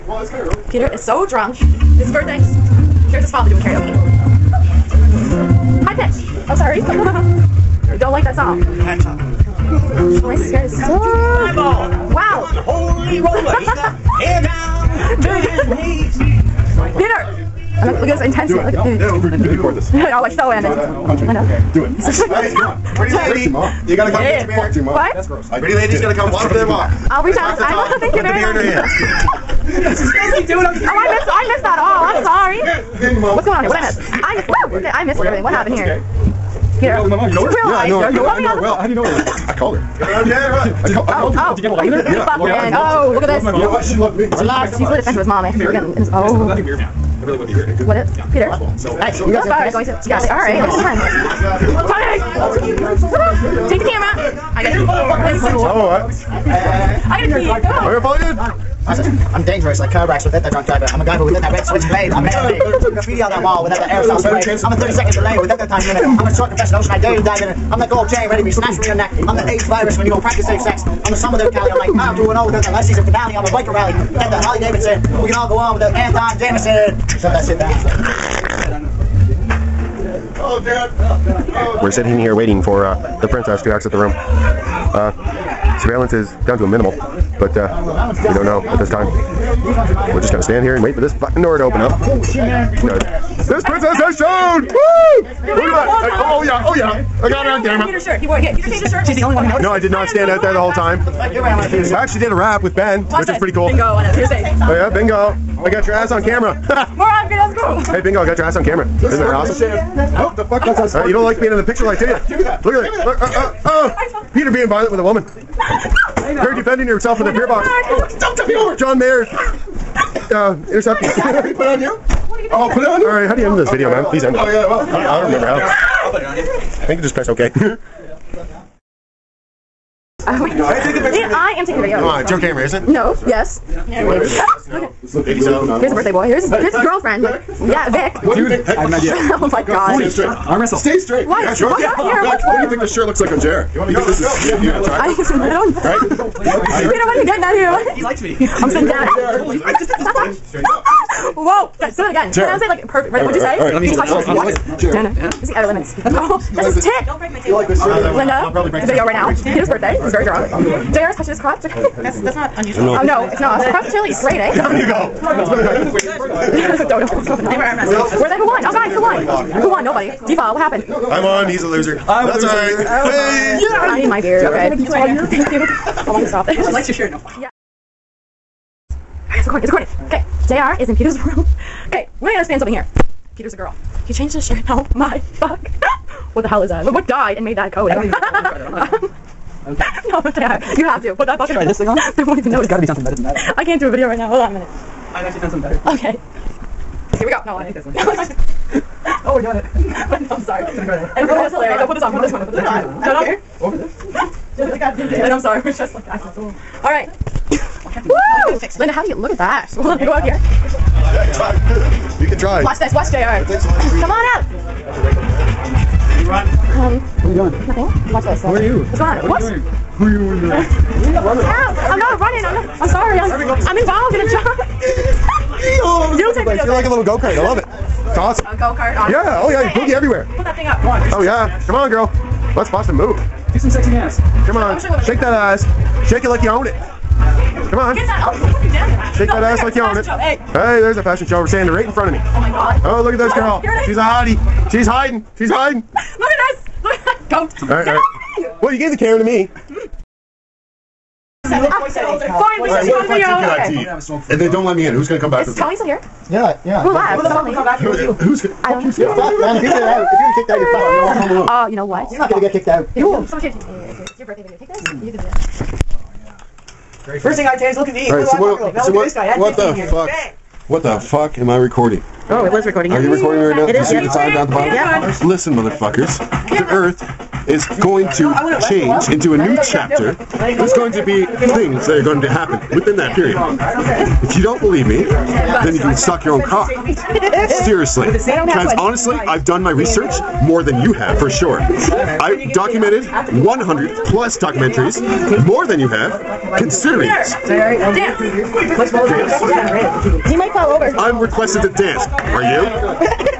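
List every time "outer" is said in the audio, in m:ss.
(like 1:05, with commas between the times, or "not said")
2:35.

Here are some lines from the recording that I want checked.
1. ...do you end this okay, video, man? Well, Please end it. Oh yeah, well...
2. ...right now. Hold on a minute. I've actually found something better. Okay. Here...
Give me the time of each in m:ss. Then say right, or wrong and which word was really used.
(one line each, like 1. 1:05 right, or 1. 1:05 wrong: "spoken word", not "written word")
1. 2:03 right
2. 3:14 right.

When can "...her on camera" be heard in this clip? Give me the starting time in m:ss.
1:37.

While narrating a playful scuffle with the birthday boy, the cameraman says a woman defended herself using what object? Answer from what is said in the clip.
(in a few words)
Beer box.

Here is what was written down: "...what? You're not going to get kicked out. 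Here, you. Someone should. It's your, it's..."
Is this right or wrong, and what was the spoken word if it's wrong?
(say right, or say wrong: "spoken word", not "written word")
right.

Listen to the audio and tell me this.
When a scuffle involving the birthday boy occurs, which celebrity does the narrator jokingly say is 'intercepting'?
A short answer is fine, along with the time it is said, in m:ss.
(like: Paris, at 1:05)
John Mayer, at 1:58.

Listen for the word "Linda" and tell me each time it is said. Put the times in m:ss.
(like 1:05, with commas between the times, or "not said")
2:38, 3:28.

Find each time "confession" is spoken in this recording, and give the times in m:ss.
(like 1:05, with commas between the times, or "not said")
1:06.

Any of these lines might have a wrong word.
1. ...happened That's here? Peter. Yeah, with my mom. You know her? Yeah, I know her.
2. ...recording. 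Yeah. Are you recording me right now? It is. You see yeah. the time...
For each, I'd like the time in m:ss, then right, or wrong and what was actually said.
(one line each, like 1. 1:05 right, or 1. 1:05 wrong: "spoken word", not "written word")
1. 0:35 right
2. 4:32 right.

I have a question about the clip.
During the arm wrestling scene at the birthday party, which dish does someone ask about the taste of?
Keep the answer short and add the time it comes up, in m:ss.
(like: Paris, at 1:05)
Chili, at 2:43.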